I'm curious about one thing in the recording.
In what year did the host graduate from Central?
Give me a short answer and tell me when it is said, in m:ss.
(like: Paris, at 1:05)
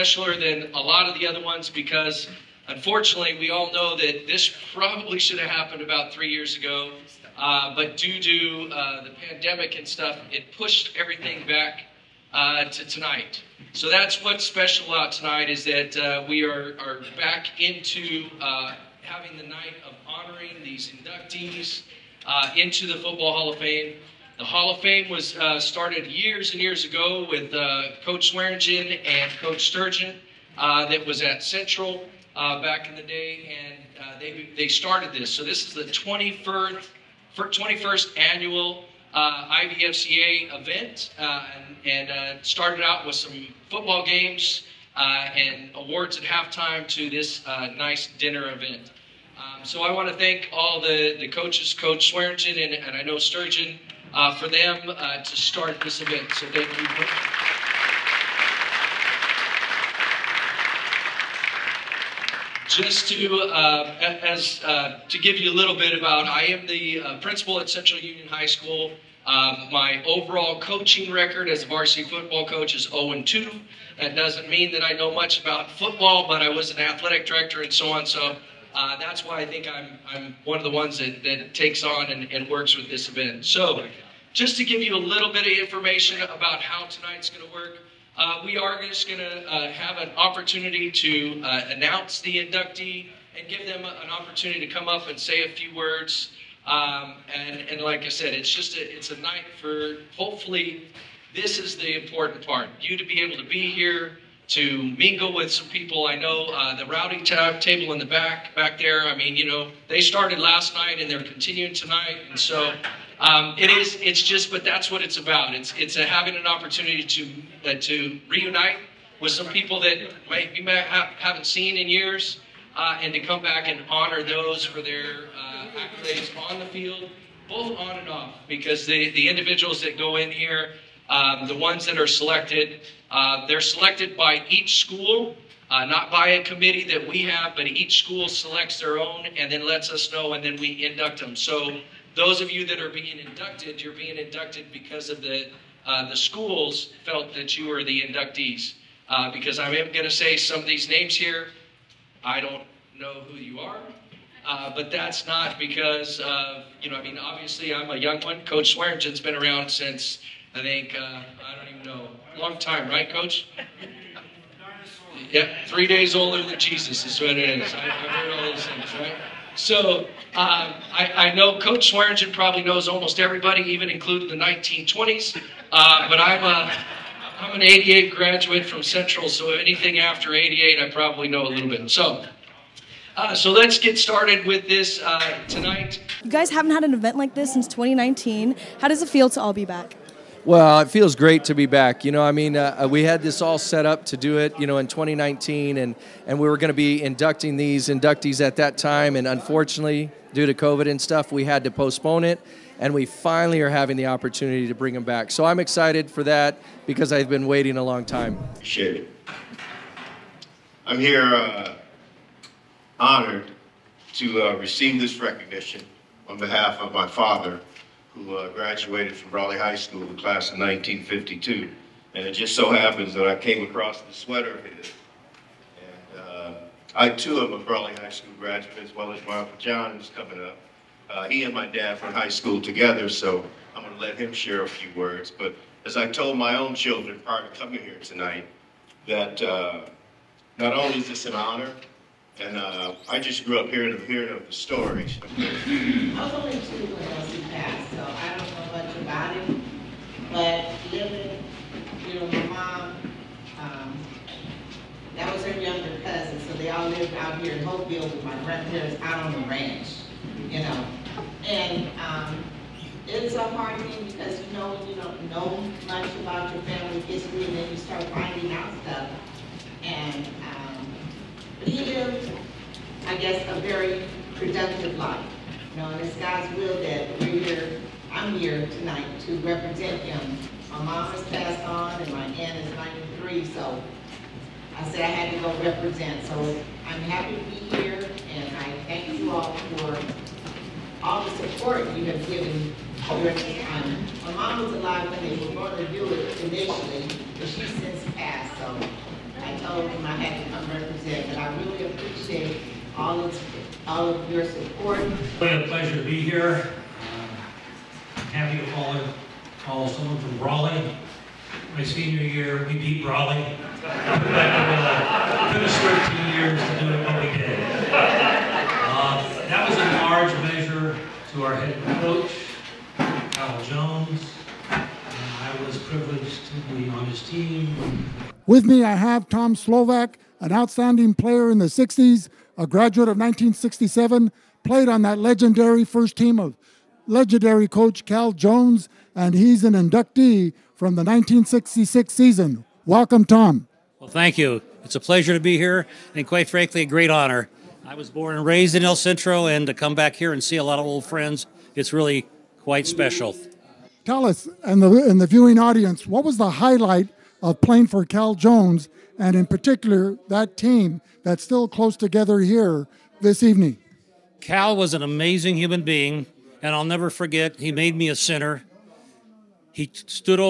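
1988, at 2:57.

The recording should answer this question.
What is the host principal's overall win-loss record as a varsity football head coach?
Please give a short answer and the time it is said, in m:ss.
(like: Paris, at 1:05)
0-2, at 1:12.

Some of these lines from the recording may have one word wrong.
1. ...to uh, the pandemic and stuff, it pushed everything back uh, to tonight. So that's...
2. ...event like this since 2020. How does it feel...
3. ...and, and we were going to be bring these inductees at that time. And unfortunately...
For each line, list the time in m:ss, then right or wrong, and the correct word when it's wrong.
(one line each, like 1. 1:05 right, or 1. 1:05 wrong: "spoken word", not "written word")
1. 0:08 right
2. 3:06 wrong: "2019", not "2020"
3. 3:15 wrong: "inducting", not "bring".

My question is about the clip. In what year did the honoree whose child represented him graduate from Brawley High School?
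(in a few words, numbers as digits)
1952.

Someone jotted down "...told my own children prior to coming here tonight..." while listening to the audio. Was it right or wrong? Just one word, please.
right.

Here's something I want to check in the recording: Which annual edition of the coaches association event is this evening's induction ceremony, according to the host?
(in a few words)
21st.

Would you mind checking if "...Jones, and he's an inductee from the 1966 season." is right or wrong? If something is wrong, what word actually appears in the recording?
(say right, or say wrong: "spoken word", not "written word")
right.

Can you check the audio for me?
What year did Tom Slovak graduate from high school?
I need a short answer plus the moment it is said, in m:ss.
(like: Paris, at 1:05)
1967, at 5:32.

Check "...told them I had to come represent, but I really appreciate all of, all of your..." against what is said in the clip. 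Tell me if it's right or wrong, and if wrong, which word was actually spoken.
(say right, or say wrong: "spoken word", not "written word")
right.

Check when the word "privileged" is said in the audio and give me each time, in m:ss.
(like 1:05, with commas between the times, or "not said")
5:25.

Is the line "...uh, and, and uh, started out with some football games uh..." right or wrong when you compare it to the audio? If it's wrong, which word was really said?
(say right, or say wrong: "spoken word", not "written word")
right.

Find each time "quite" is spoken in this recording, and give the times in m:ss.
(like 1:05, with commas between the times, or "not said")
5:46, 5:52.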